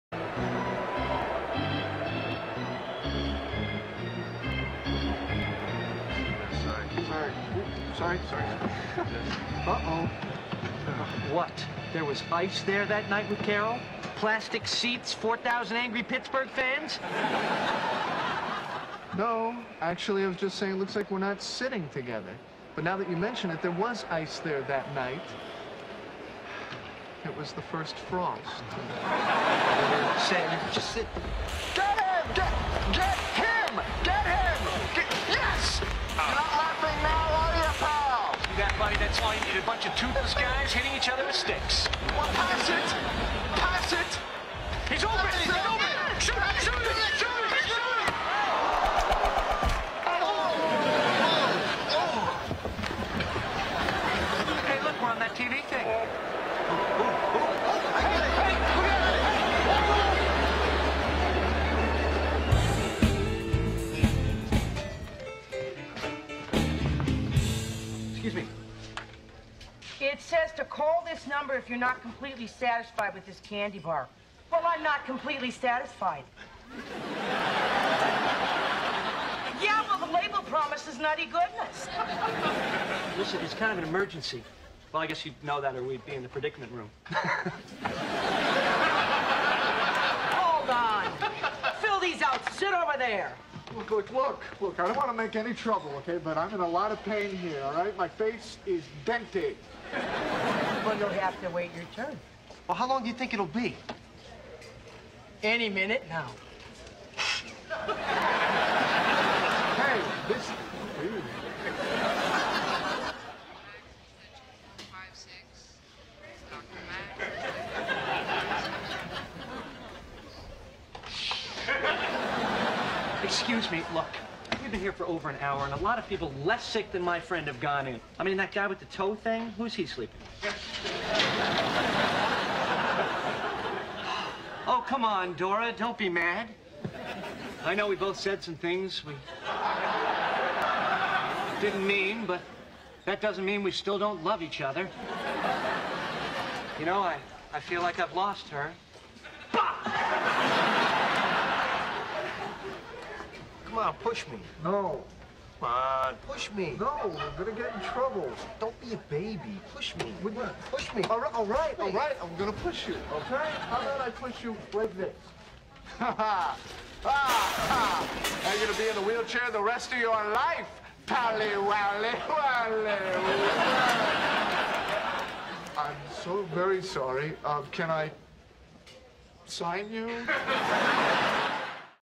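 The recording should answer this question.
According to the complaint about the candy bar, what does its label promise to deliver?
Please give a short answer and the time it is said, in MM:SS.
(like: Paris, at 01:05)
Nutty goodness, at 01:20.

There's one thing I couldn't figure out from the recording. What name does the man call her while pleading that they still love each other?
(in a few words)
Dora.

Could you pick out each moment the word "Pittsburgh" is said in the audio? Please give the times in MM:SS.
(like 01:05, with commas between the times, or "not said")
00:16.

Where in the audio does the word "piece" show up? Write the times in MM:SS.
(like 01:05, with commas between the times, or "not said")
not said.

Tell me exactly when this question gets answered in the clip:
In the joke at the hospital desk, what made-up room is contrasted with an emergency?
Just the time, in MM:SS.
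01:26.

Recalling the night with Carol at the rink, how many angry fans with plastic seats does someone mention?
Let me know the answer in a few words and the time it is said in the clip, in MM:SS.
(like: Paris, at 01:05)
4,000, at 00:15.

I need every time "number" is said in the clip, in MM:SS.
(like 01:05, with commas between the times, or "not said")
01:11.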